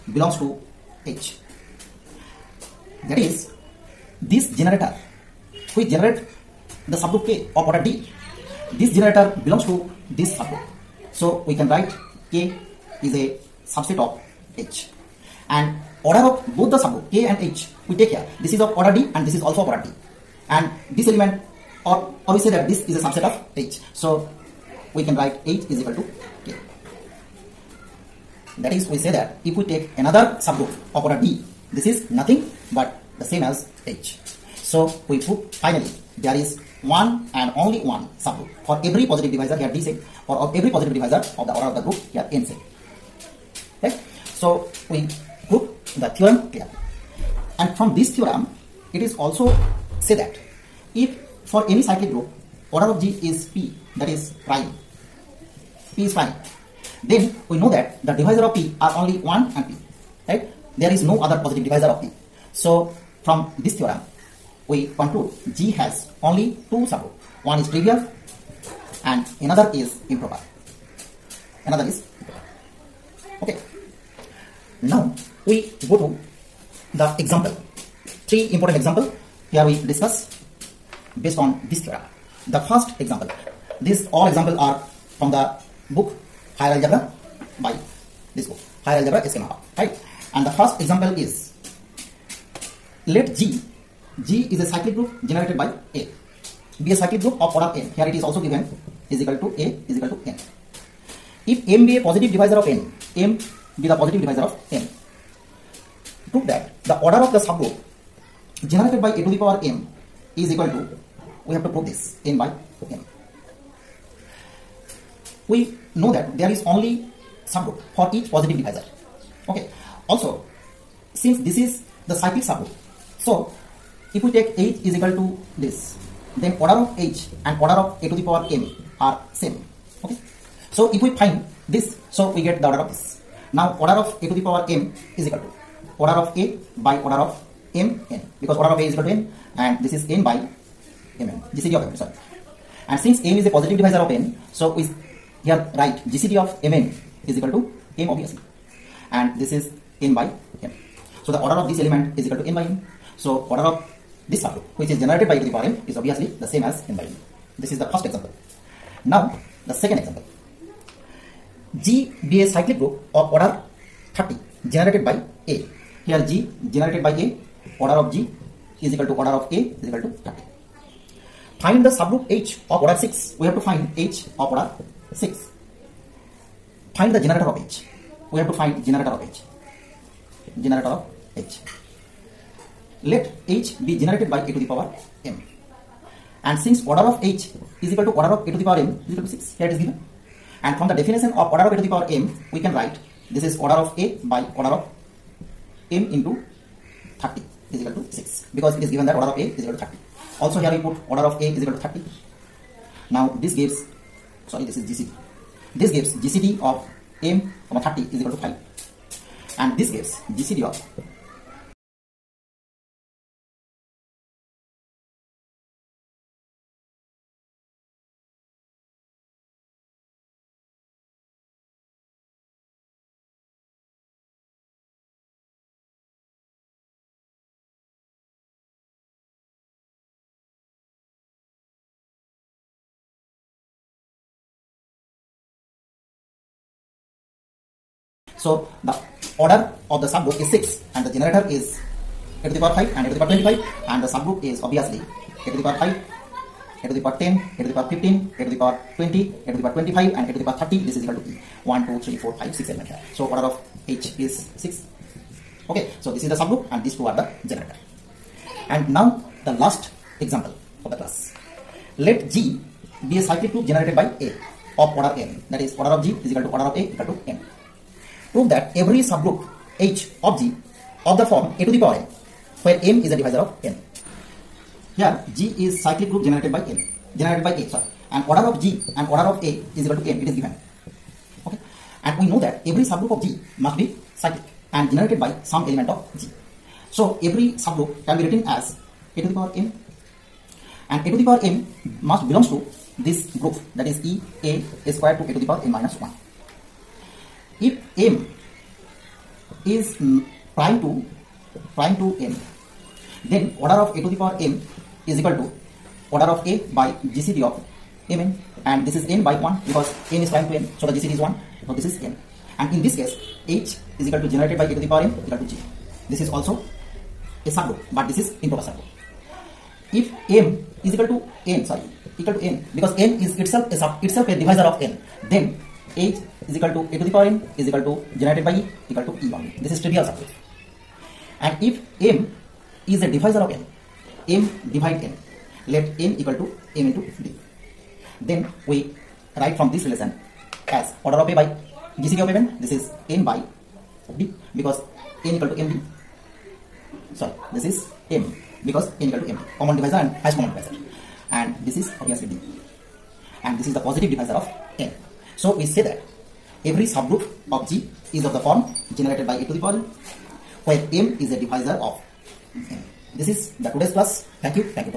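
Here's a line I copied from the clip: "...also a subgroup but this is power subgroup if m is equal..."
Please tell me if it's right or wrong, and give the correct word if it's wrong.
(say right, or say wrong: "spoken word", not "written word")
wrong: "improper", not "power".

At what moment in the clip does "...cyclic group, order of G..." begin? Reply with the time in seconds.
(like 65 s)
51 s.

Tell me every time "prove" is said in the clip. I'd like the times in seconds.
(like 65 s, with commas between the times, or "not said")
106 s, 111 s, 268 s.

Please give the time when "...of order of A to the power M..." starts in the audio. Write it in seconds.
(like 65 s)
191 s.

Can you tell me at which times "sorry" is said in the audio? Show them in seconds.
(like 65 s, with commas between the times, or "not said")
142 s, 204 s, 277 s, 321 s, 347 s.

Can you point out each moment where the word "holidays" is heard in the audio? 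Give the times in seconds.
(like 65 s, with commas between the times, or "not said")
not said.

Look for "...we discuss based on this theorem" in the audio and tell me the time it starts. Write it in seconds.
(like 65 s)
79 s.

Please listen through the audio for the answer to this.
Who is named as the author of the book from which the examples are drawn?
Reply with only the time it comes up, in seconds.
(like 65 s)
89 s.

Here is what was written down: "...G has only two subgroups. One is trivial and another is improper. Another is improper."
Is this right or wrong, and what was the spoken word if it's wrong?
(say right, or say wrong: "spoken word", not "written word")
right.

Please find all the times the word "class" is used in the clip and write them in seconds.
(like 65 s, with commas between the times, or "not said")
260 s, 363 s.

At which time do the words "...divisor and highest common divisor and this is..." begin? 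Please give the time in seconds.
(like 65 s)
349 s.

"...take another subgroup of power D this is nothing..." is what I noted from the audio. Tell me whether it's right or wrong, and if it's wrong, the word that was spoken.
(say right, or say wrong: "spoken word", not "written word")
wrong: "order", not "power".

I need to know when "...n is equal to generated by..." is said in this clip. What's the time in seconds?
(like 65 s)
327 s.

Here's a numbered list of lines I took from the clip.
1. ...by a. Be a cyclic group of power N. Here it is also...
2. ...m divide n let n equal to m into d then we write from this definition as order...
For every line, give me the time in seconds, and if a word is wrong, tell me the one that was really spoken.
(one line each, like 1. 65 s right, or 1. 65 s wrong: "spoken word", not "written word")
1. 95 s wrong: "order", not "power"
2. 334 s wrong: "relation", not "definition".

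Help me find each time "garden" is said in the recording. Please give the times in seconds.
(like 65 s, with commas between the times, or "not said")
not said.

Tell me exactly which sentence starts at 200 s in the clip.
Also here we put order of A is equal to 30.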